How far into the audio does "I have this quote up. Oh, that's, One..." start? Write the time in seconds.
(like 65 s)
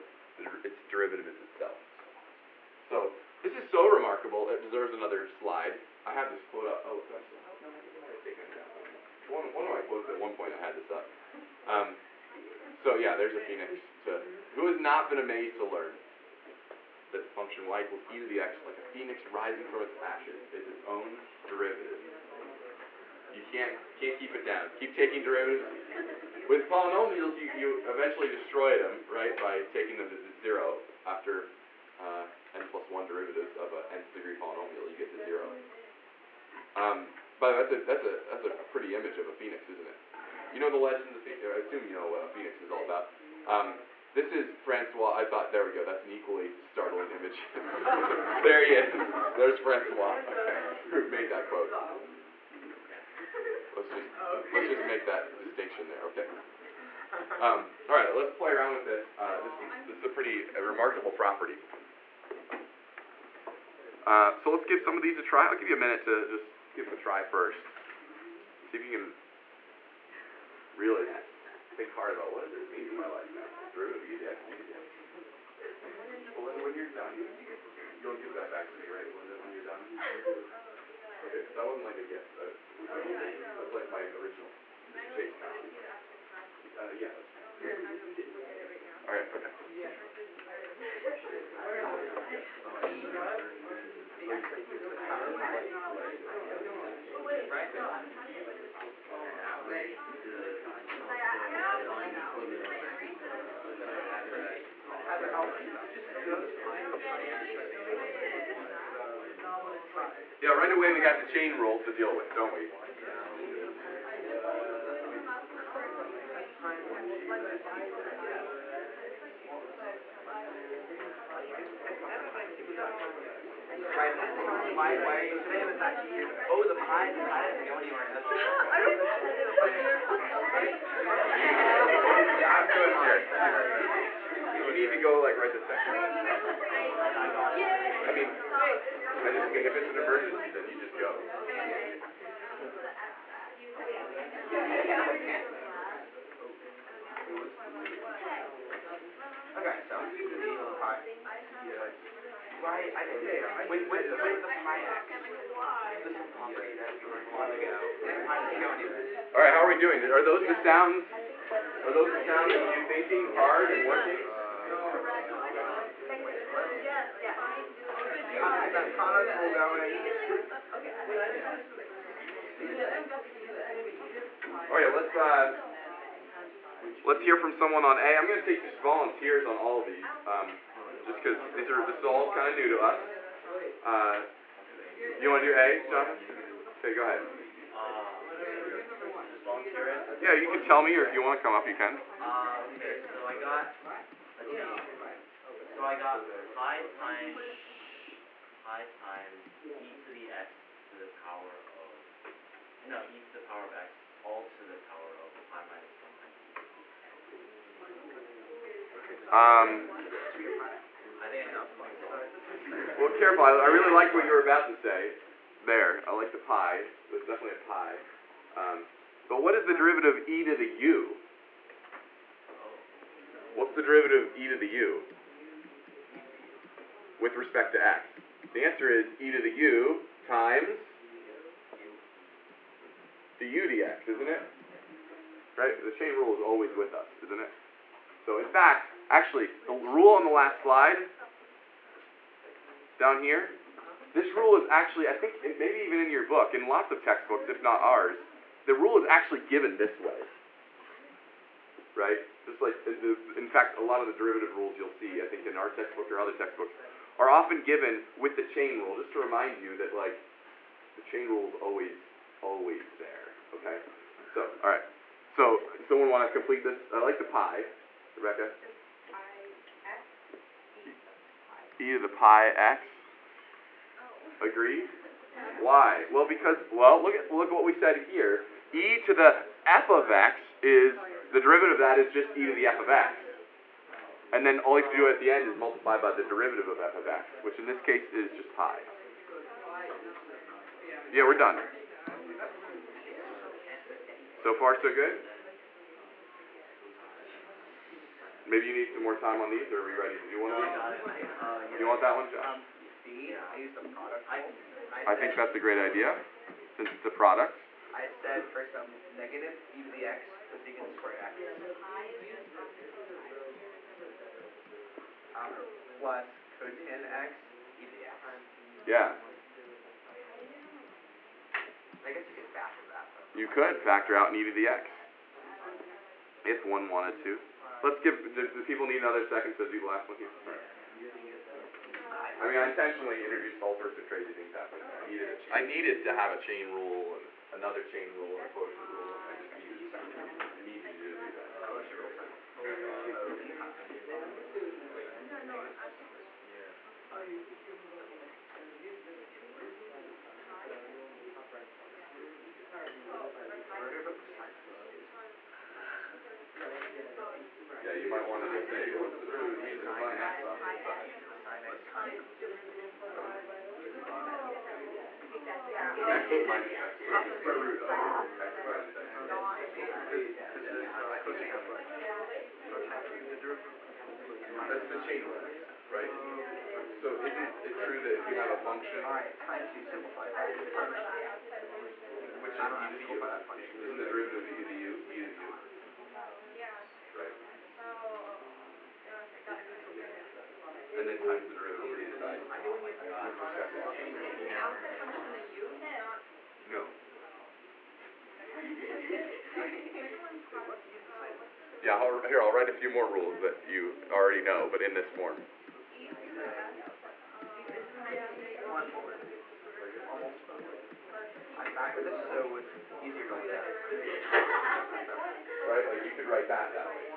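6 s.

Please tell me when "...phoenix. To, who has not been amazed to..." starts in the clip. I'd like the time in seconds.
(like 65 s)
13 s.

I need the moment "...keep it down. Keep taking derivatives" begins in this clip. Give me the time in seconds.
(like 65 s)
24 s.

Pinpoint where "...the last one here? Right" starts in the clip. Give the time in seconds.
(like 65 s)
329 s.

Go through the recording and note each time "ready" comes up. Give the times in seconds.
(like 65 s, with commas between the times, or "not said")
299 s.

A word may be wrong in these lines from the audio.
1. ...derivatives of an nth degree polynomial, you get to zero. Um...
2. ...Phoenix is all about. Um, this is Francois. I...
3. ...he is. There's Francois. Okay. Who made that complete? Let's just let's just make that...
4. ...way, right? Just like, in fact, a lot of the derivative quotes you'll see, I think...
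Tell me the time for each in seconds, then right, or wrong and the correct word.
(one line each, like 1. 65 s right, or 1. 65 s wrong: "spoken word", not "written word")
1. 33 s right
2. 42 s right
3. 48 s wrong: "quote", not "complete"
4. 249 s wrong: "rules", not "quotes".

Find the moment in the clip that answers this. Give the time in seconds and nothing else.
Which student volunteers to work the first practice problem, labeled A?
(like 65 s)
185 s.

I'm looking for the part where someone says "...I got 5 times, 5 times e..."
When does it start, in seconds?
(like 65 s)
195 s.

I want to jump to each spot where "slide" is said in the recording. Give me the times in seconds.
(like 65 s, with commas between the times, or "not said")
5 s, 240 s.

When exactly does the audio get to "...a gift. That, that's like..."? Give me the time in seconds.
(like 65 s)
81 s.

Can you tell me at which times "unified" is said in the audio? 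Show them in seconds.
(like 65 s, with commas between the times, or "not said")
not said.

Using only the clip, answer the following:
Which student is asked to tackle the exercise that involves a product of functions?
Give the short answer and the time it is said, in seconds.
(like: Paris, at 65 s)
Josh, at 302 s.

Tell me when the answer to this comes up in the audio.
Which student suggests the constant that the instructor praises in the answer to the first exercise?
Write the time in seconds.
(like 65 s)
268 s.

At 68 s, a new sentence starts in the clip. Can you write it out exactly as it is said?
See if you can really think hard about what does this mean for my life now?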